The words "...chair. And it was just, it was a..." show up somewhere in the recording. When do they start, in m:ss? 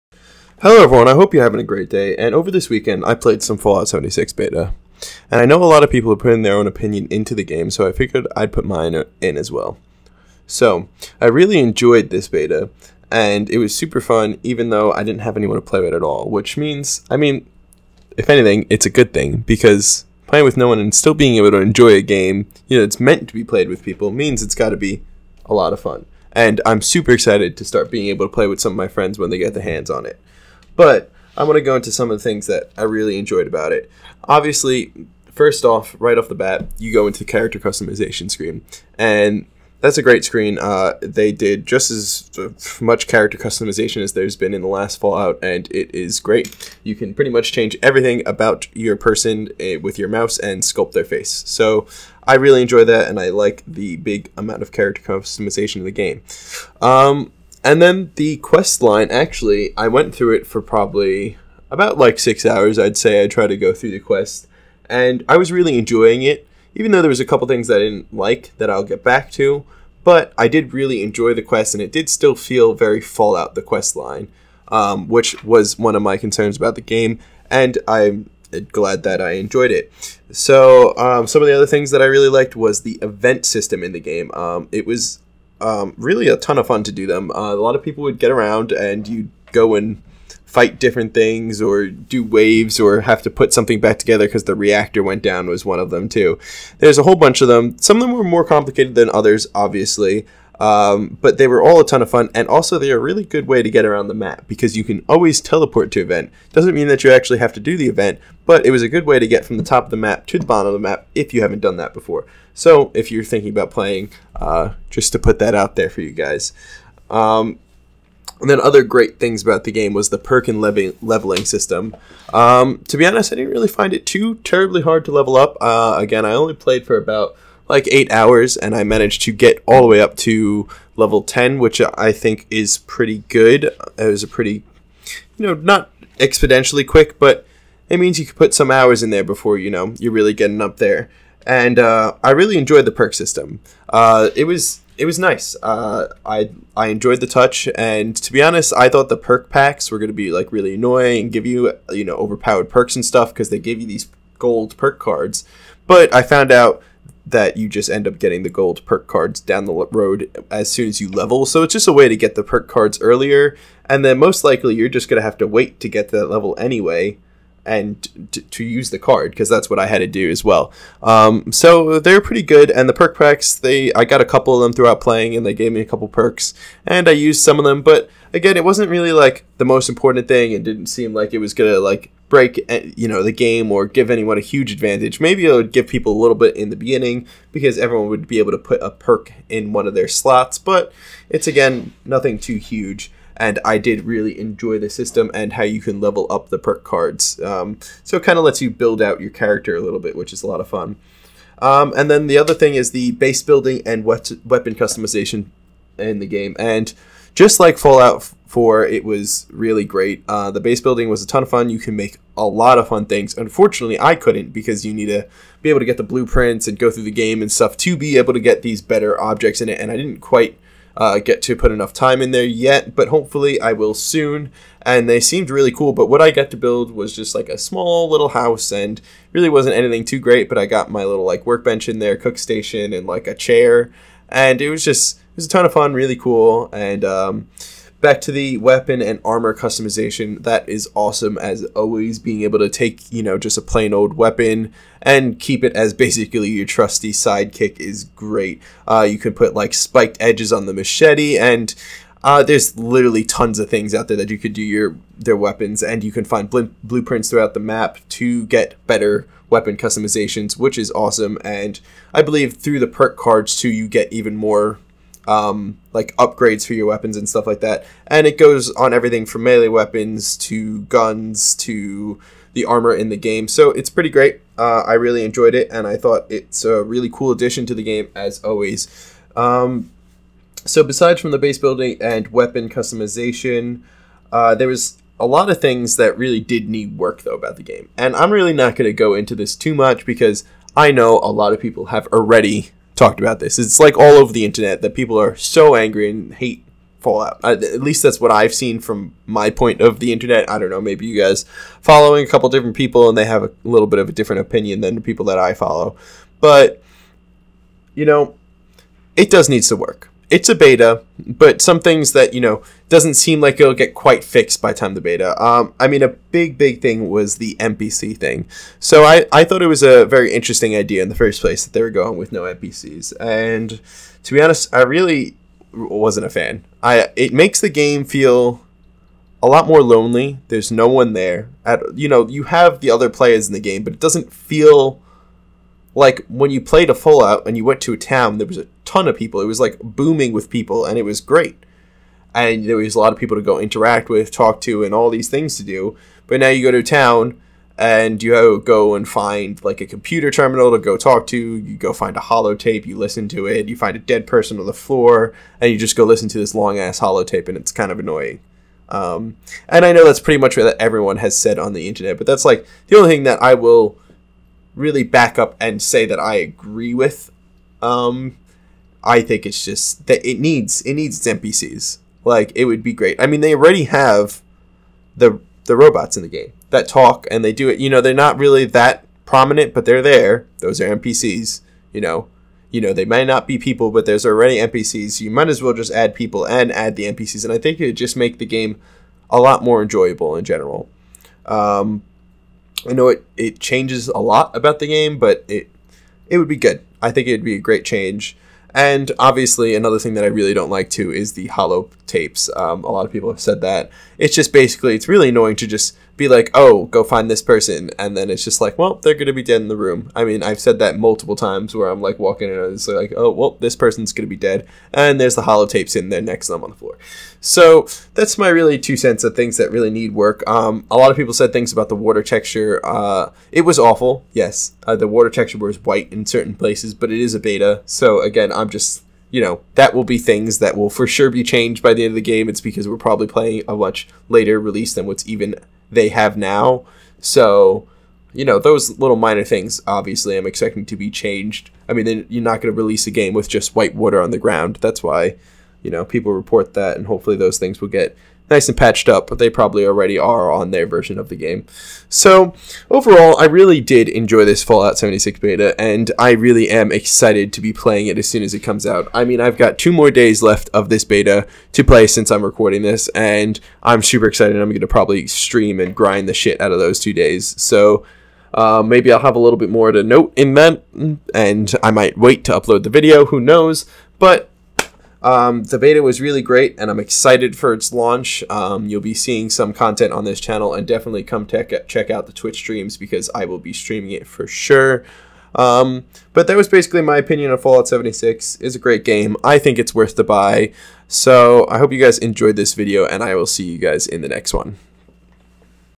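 3:53.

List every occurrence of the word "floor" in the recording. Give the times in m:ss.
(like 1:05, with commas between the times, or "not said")
5:54, 6:56.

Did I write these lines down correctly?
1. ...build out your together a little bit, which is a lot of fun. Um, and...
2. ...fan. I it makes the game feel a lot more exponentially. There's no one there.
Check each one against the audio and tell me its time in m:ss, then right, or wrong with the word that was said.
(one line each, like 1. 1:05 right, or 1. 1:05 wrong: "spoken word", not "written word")
1. 3:18 wrong: "character", not "together"
2. 5:26 wrong: "lonely", not "exponentially".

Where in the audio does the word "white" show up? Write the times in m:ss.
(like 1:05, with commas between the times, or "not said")
7:05, 7:23.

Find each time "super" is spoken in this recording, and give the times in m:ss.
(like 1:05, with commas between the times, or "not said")
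0:13, 0:26, 7:44.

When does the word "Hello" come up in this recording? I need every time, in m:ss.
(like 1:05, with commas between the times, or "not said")
0:00.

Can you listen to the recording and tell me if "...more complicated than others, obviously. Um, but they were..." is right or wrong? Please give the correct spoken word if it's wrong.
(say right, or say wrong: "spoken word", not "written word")
right.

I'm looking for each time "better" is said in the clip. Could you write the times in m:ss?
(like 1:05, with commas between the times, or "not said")
3:38, 4:18.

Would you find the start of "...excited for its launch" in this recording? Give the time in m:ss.
7:56.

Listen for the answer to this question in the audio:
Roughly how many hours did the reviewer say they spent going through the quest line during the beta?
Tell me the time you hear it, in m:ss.
1:02.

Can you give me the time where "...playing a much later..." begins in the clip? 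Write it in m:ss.
7:13.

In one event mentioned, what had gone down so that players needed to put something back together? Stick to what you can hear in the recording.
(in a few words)
The reactor.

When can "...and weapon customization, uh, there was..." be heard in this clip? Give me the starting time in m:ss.
4:42.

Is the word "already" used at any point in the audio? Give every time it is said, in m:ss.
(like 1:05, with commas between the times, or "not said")
4:52, 6:13, 6:24, 7:29.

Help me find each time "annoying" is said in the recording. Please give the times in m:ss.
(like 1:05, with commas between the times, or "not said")
2:30, 5:57, 6:45.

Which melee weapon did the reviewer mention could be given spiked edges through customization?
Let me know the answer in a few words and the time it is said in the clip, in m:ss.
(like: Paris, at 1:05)
Machete, at 4:10.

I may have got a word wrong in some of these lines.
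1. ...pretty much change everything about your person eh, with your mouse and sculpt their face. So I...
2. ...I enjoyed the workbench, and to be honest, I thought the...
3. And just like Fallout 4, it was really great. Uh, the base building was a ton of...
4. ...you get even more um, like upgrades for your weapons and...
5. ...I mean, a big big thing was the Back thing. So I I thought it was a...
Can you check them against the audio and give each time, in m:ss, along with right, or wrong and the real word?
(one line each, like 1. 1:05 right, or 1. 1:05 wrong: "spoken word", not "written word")
1. 0:47 right
2. 2:26 wrong: "touch", not "workbench"
3. 3:26 right
4. 4:23 right
5. 5:15 wrong: "NPC", not "Back".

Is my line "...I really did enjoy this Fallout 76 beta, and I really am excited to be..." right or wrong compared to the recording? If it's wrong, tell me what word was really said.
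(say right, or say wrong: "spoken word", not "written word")
right.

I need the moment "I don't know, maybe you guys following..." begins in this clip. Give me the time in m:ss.
5:00.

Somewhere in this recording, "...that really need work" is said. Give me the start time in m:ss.
6:59.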